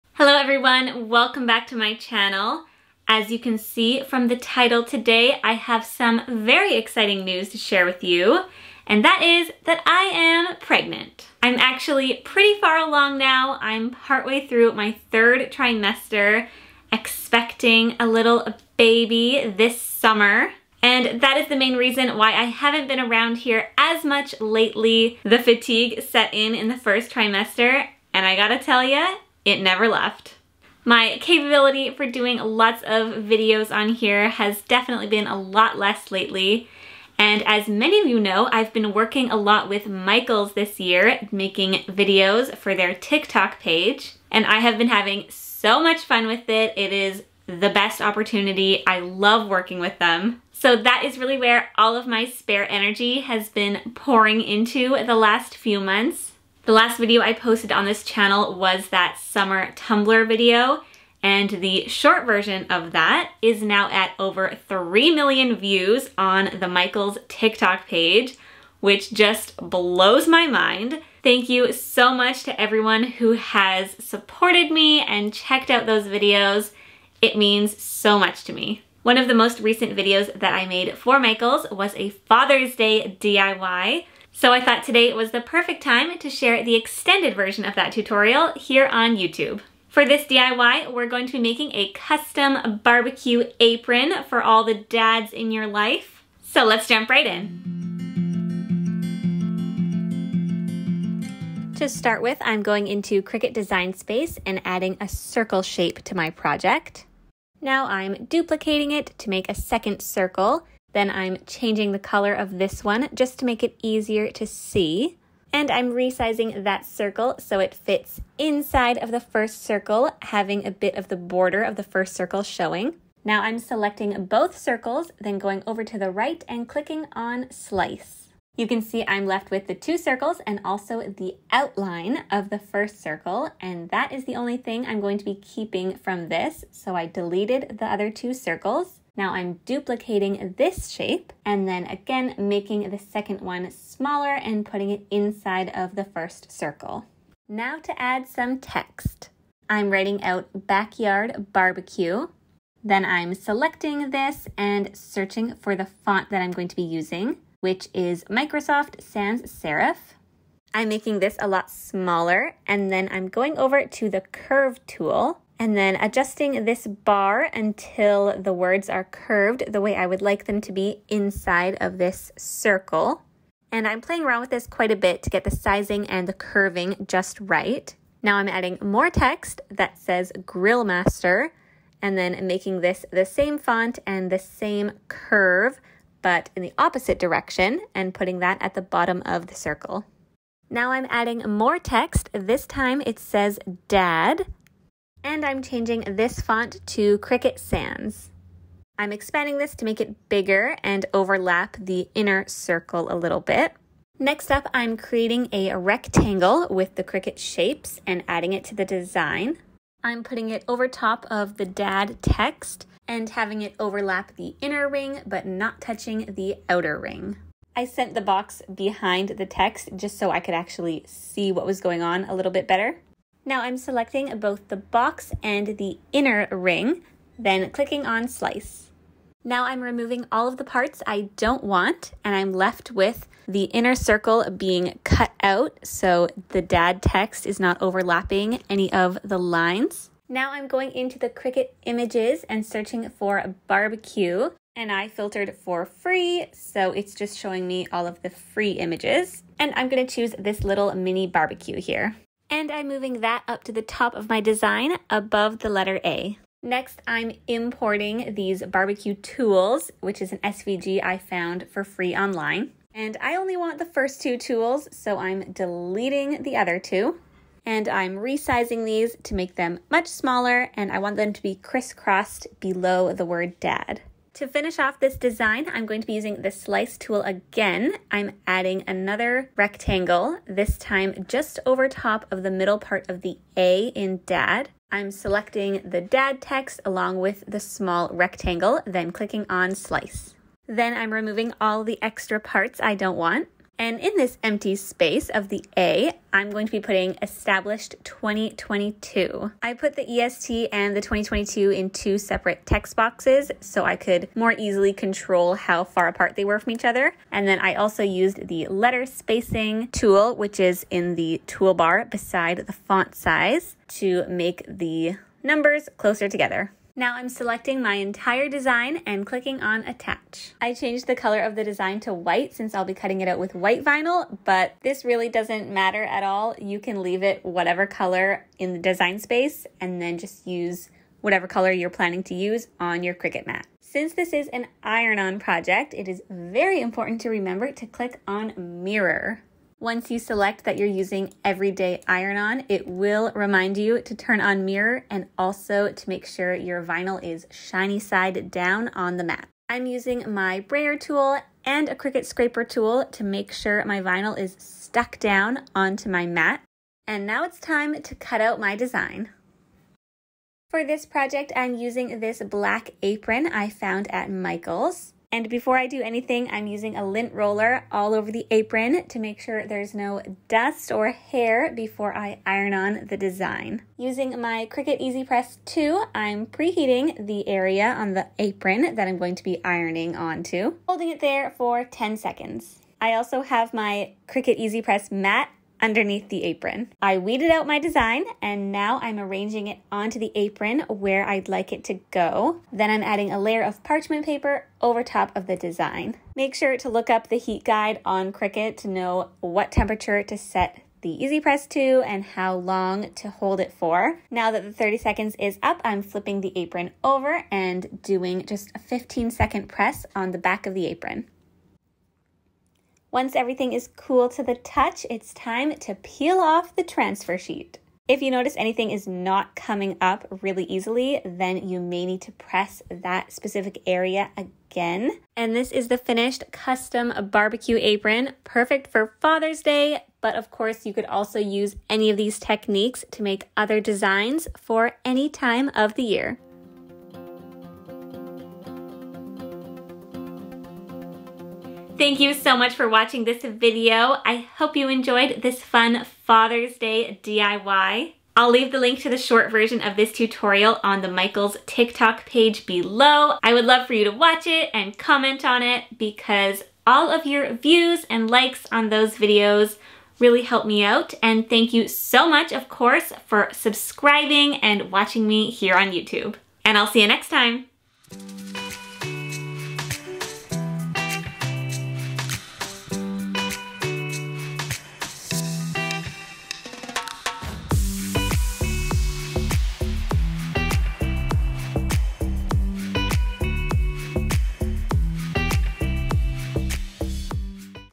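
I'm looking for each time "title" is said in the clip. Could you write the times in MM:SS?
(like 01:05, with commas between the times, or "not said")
00:04.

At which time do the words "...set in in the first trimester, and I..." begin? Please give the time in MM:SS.
00:26.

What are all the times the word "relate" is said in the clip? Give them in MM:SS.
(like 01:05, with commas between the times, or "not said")
not said.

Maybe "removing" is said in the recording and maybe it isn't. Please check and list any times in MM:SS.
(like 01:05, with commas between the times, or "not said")
03:49, 04:51.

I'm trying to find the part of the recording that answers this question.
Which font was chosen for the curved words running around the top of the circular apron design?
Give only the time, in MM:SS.
02:38.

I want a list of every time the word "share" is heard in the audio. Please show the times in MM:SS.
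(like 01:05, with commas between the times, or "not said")
00:07, 01:26.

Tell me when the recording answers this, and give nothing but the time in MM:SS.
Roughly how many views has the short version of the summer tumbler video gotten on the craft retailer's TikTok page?
01:04.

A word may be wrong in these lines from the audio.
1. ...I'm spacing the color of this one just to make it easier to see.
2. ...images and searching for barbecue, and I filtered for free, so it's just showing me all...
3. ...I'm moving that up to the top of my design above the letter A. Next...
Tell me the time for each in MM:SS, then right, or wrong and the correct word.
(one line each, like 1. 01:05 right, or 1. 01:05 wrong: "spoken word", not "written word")
1. 01:51 wrong: "changing", not "spacing"
2. 04:01 right
3. 04:12 right.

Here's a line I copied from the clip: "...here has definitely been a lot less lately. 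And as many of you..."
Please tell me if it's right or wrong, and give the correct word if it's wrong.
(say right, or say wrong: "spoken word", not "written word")
right.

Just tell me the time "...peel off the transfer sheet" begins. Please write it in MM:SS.
06:55.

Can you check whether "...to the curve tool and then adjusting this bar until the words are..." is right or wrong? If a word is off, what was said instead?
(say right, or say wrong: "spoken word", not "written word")
right.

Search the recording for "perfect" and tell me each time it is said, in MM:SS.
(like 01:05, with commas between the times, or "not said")
01:25, 07:08.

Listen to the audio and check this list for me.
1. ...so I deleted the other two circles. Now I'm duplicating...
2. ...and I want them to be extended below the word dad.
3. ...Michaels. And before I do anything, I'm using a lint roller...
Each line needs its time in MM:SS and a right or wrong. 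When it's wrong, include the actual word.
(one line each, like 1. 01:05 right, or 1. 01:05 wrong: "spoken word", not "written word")
1. 02:16 right
2. 04:30 wrong: "crisscrossed", not "extended"
3. 06:04 right.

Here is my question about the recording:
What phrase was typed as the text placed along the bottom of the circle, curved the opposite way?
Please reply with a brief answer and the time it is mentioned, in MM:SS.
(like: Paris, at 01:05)
Grill Master, at 03:00.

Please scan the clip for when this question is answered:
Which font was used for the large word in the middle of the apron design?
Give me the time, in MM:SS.
03:17.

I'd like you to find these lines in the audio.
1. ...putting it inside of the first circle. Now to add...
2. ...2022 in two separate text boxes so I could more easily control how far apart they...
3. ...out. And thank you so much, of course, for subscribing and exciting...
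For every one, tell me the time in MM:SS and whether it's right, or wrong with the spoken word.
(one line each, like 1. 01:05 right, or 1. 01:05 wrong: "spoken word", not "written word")
1. 02:24 right
2. 05:01 right
3. 07:40 wrong: "watching", not "exciting".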